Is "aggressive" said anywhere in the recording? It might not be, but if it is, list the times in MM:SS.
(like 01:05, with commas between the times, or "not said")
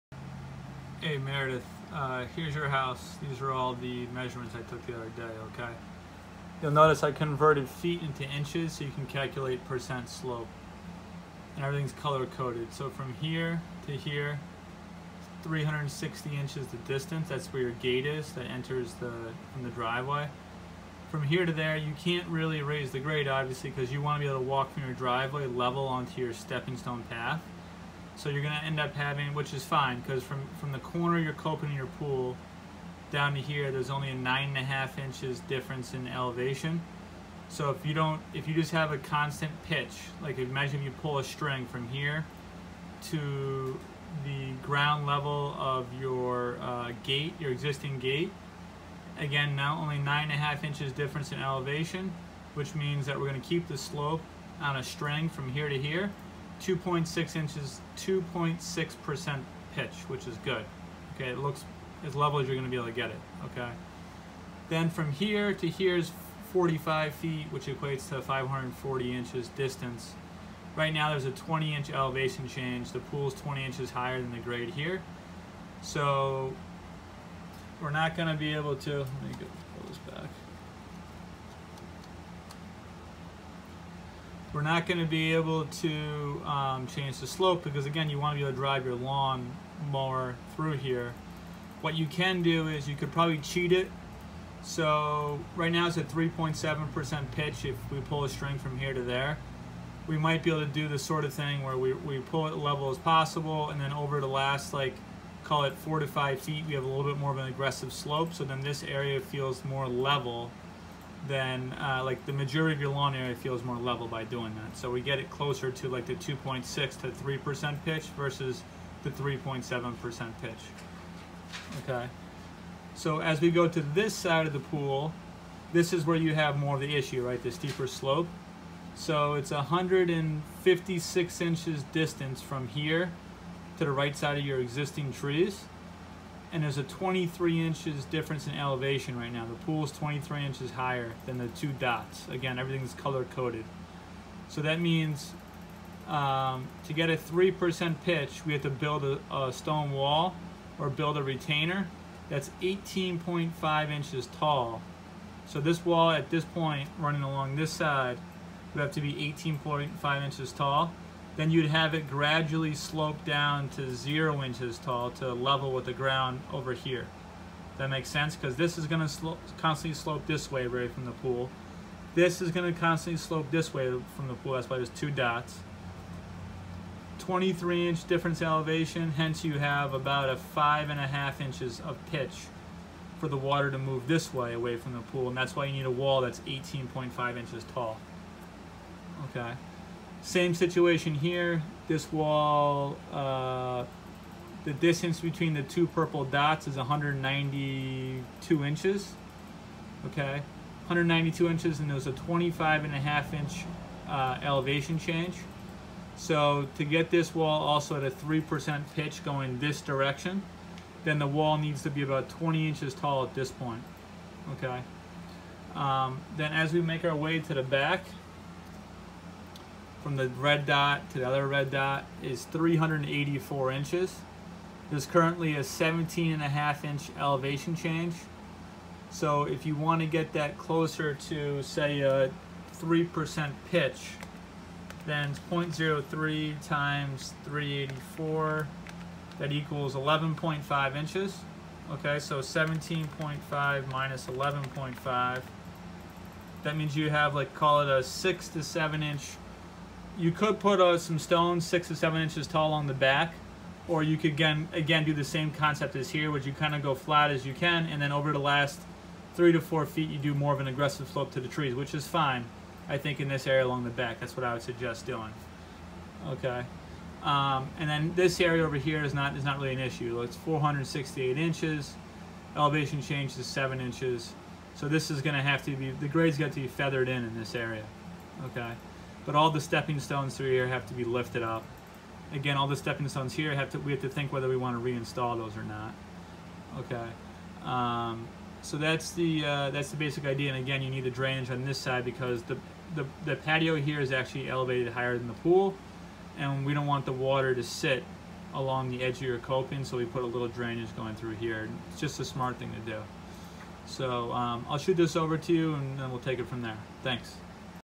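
01:47, 04:20.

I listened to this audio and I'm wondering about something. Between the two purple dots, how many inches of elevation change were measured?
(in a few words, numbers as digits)
25.5 inches.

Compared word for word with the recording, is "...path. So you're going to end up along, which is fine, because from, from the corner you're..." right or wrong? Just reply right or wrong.
wrong.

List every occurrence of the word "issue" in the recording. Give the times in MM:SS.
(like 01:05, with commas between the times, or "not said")
02:06, 04:29.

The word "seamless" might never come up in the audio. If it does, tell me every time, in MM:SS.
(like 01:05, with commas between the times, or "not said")
not said.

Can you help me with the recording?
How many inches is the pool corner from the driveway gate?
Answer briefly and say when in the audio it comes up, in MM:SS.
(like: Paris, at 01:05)
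360 inches, at 00:15.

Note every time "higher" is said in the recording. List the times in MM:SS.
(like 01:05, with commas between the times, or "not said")
01:13, 02:20, 04:54.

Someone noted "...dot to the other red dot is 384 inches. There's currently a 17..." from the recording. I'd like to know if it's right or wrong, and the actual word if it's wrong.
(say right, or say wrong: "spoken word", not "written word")
right.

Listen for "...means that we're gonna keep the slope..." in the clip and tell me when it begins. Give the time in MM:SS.
00:52.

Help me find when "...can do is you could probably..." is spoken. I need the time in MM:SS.
01:32.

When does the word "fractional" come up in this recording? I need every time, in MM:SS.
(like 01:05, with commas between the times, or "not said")
not said.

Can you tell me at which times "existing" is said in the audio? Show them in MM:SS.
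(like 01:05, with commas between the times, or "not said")
00:47, 02:14.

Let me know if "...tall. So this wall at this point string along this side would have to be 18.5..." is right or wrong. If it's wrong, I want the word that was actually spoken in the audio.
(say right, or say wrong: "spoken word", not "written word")
wrong: "running", not "string".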